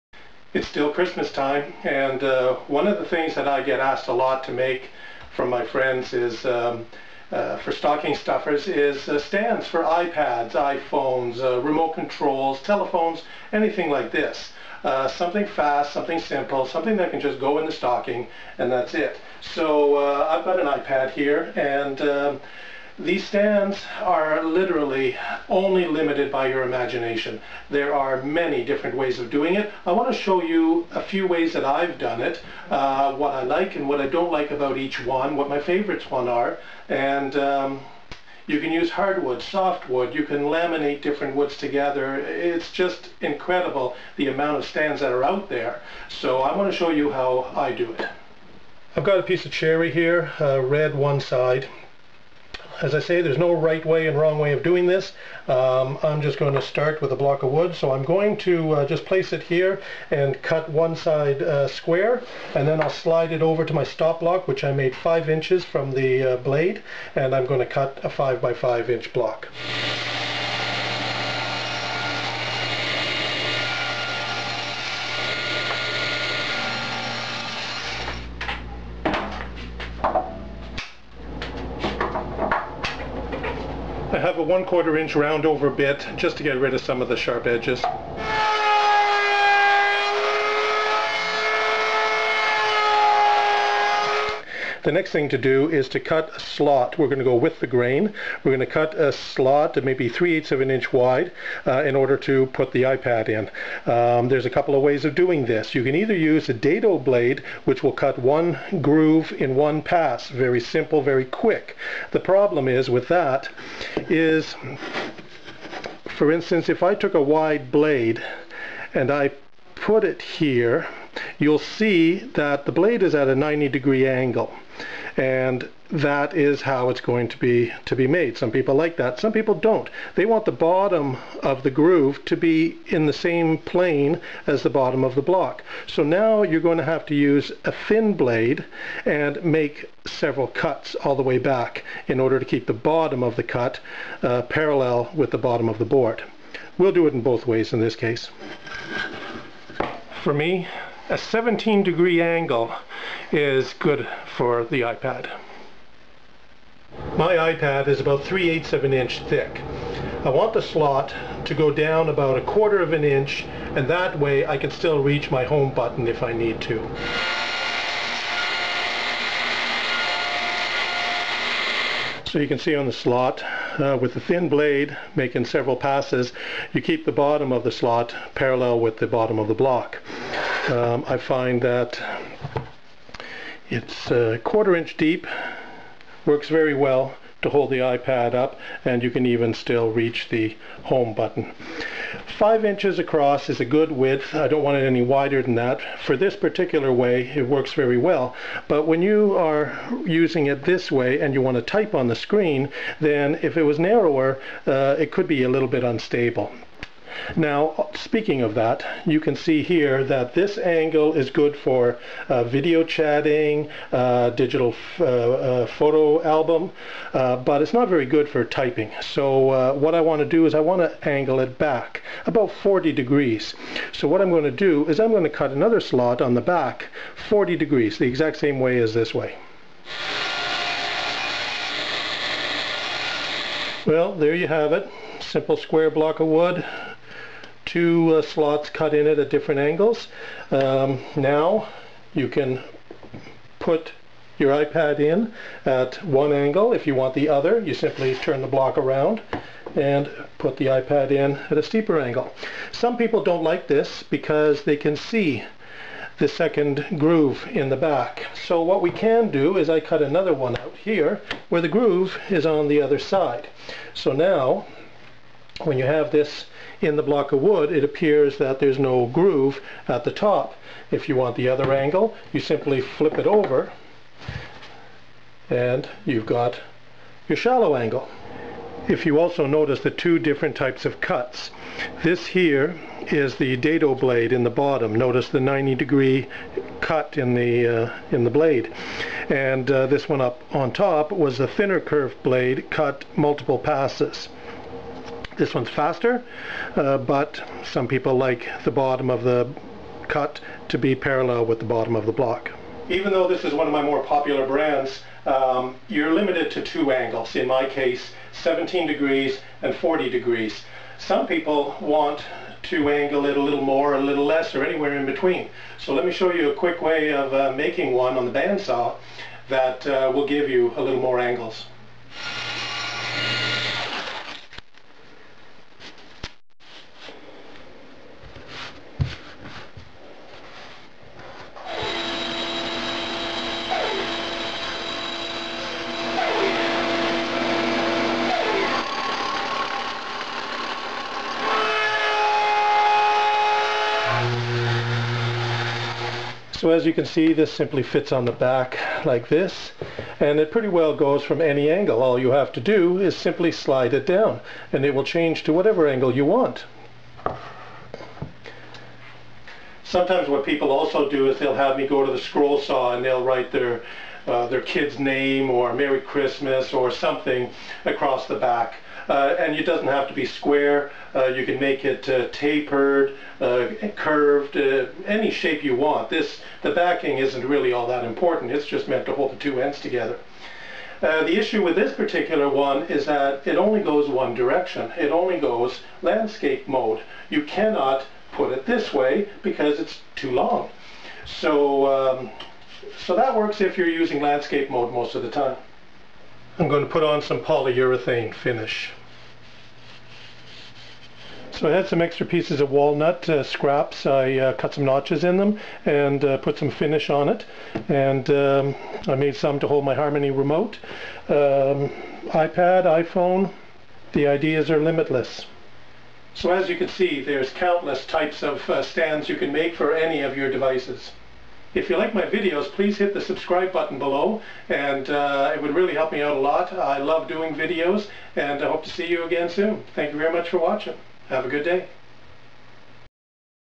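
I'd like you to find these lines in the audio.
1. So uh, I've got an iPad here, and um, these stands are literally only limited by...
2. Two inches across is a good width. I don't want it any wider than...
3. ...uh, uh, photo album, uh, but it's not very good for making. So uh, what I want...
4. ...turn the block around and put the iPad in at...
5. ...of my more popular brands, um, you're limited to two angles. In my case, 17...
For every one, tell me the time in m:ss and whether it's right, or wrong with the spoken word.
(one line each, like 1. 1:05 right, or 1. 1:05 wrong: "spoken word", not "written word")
1. 0:19 right
2. 3:12 wrong: "Five", not "Two"
3. 3:34 wrong: "typing", not "making"
4. 4:08 right
5. 5:03 right.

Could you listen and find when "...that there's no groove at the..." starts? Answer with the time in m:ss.
4:28.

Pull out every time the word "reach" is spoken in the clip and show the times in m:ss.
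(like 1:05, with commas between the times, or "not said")
2:45, 3:09.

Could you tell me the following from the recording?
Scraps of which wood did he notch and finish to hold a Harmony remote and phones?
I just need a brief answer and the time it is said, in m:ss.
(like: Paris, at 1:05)
Walnut, at 6:42.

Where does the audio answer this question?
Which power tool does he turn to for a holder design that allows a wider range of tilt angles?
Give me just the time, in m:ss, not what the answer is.
5:18.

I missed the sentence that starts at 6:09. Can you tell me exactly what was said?
Uh, and it doesn't have to be square.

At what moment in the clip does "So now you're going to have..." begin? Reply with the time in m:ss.
2:15.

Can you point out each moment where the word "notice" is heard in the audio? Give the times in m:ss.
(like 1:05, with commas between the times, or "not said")
4:39, 4:44.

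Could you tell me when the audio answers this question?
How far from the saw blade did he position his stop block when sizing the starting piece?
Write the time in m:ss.
1:04.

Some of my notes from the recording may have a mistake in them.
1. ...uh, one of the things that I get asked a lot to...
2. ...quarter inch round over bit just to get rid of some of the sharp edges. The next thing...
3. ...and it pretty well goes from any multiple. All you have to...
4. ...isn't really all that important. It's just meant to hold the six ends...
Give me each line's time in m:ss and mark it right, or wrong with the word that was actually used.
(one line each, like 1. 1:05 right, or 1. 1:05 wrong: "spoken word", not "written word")
1. 0:02 right
2. 1:24 right
3. 5:50 wrong: "angle", not "multiple"
4. 6:17 wrong: "two", not "six".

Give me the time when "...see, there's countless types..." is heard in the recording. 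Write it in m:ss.
6:56.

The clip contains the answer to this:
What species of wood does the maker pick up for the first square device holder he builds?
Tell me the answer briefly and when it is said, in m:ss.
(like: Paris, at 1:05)
Cherry, at 0:49.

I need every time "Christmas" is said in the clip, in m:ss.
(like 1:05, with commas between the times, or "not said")
0:00, 6:05.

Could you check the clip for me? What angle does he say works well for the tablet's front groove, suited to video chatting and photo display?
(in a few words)
17 degrees.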